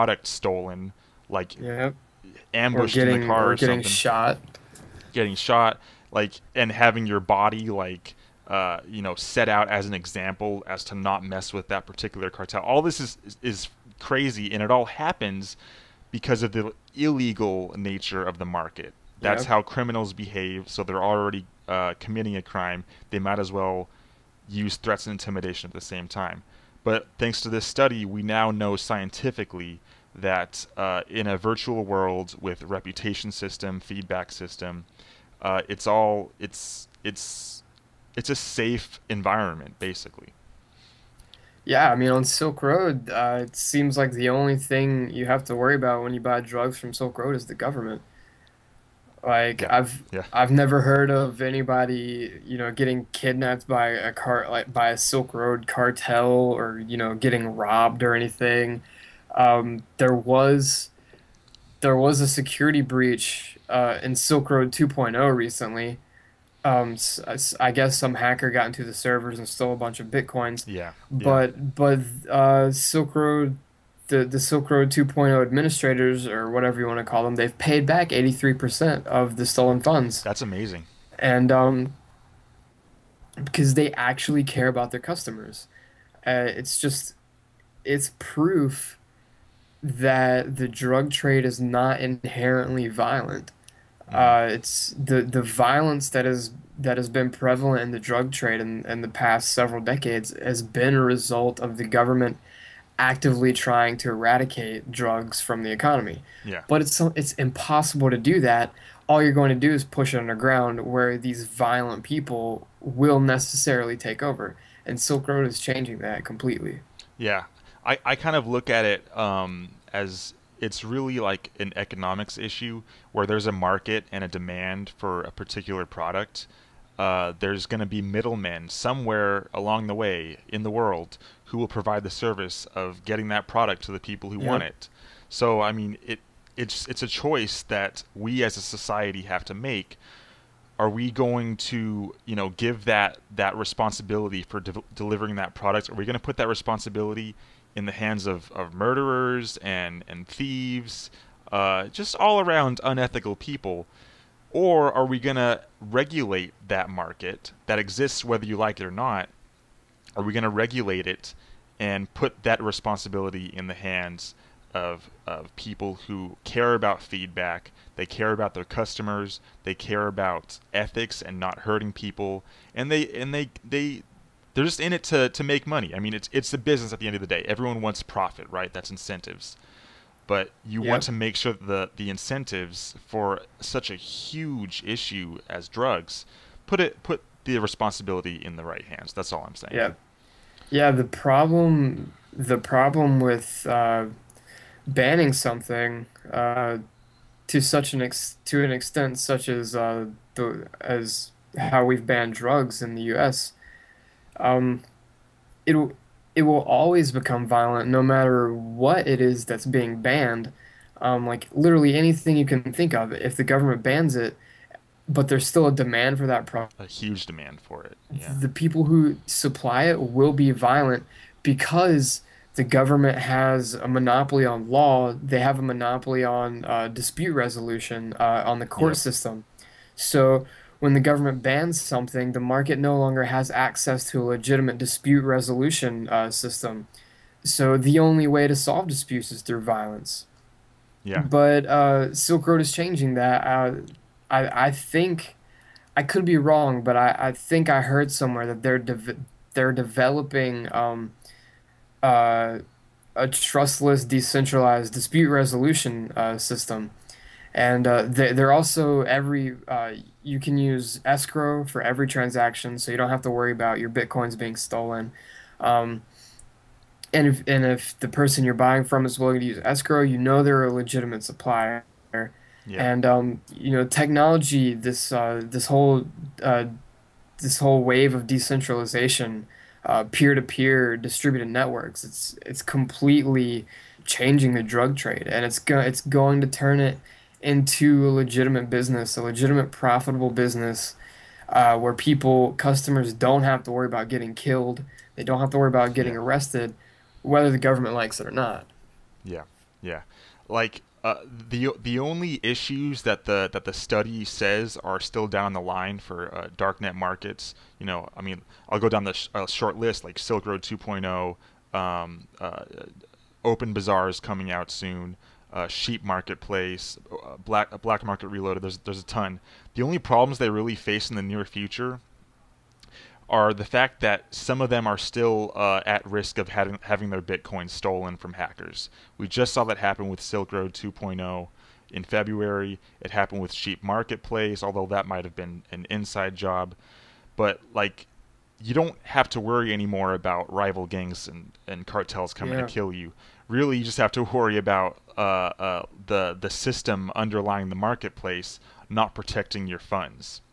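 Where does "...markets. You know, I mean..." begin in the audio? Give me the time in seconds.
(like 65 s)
306 s.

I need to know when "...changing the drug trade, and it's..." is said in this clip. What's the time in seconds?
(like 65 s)
284 s.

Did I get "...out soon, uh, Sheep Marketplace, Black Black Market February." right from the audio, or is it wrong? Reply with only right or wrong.
wrong.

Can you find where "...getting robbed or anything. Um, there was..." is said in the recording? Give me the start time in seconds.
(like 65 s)
57 s.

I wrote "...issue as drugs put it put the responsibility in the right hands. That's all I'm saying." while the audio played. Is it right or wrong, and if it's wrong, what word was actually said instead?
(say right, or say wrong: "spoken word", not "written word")
right.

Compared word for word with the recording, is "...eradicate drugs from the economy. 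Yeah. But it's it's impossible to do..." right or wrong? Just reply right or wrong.
right.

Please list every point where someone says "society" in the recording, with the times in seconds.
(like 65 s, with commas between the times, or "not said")
138 s.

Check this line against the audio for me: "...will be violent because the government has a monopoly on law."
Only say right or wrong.
right.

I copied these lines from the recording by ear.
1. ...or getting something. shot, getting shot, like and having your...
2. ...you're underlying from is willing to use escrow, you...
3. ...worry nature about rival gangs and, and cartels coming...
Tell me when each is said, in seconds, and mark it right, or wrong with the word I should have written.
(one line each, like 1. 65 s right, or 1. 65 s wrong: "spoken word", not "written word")
1. 3 s right
2. 268 s wrong: "buying", not "underlying"
3. 339 s wrong: "anymore", not "nature".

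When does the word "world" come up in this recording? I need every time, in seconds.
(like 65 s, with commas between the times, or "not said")
31 s, 130 s.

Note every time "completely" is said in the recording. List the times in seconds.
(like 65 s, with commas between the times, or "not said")
116 s, 282 s.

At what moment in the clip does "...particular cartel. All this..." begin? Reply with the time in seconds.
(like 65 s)
11 s.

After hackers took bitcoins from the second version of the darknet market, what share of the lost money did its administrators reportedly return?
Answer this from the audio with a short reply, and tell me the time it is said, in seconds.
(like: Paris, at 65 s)
83%, at 78 s.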